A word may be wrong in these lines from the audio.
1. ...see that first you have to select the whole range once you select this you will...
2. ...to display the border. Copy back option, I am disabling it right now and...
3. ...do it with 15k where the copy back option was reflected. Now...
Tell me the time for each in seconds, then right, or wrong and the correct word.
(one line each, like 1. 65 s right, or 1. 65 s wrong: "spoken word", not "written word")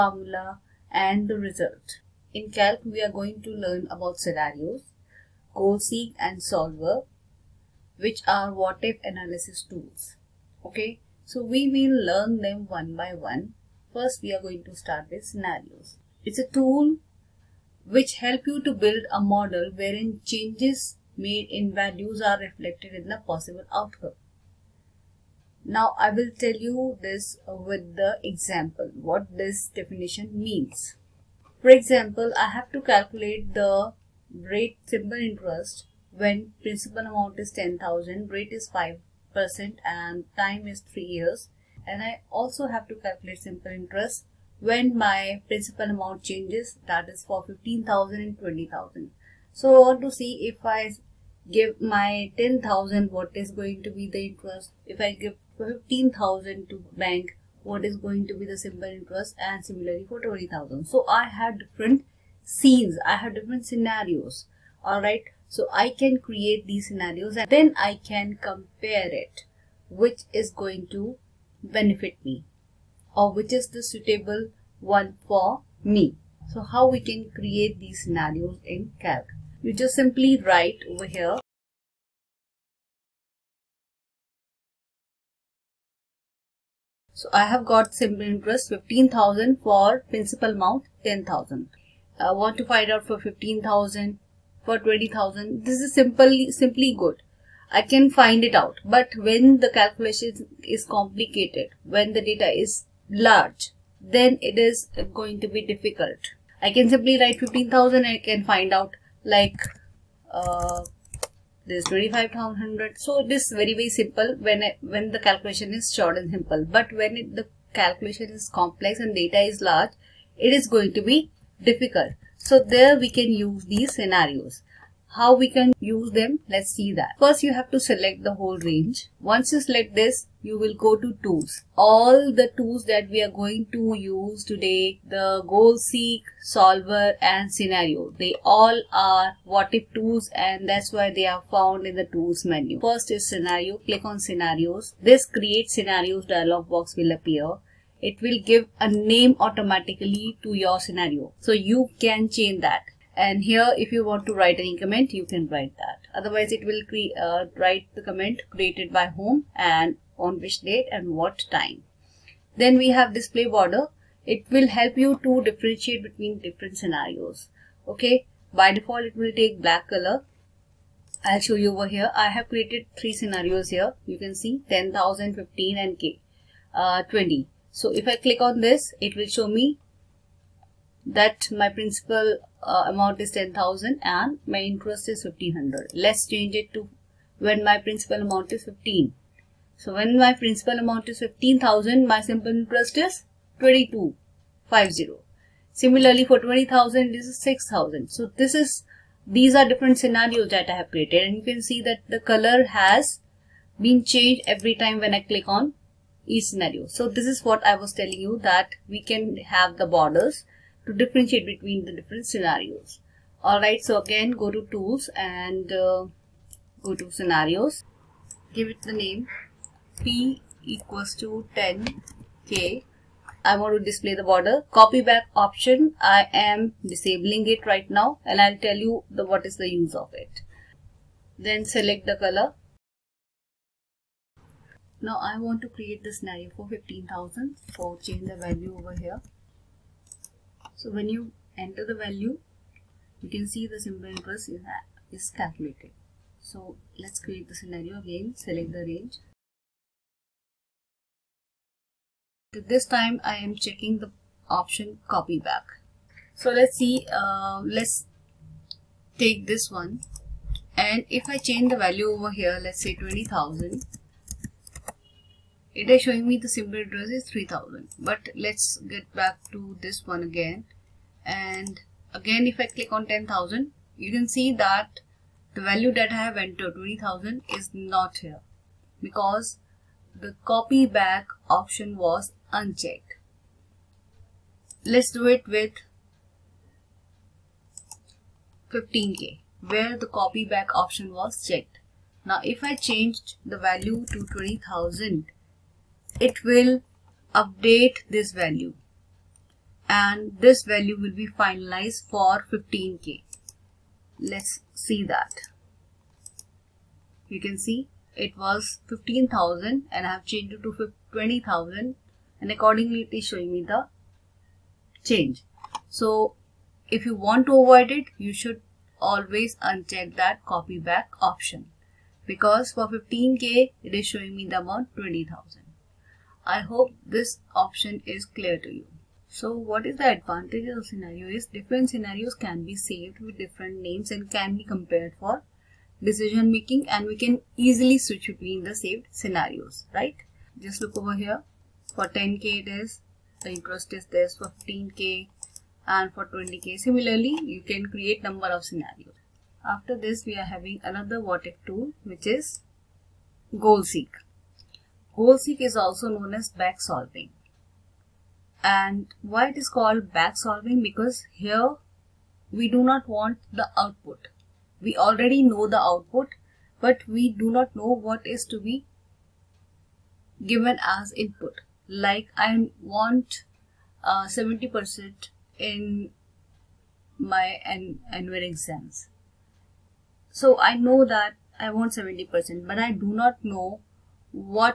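1. 126 s right
2. 223 s right
3. 285 s wrong: "checked", not "reflected".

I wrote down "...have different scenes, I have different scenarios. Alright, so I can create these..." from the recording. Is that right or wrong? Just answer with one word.
right.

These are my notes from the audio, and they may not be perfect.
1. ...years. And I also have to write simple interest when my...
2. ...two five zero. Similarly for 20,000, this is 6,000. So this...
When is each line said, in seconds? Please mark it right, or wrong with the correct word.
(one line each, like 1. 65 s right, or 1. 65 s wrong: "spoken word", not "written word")
1. 41 s wrong: "calculate", not "write"
2. 193 s right.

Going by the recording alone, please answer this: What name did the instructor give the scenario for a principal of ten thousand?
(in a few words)
P equals to 10K.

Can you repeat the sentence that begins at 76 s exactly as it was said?
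So how we can create these scenarios in Calc.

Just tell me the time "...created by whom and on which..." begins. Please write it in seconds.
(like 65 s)
158 s.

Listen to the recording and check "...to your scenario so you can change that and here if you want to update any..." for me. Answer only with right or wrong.
wrong.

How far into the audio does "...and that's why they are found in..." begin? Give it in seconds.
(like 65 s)
140 s.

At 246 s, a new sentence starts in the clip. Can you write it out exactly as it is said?
So let's create the scenario again, select the range.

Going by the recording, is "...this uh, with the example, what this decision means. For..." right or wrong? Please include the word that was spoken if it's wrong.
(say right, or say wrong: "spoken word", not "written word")
wrong: "definition", not "decision".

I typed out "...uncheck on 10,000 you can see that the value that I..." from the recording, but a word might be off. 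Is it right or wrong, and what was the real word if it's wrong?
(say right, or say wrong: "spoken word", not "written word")
wrong: "click", not "uncheck".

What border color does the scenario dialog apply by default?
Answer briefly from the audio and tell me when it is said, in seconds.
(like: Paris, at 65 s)
Black, at 169 s.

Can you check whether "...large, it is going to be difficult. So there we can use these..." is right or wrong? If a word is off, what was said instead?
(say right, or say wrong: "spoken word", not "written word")
right.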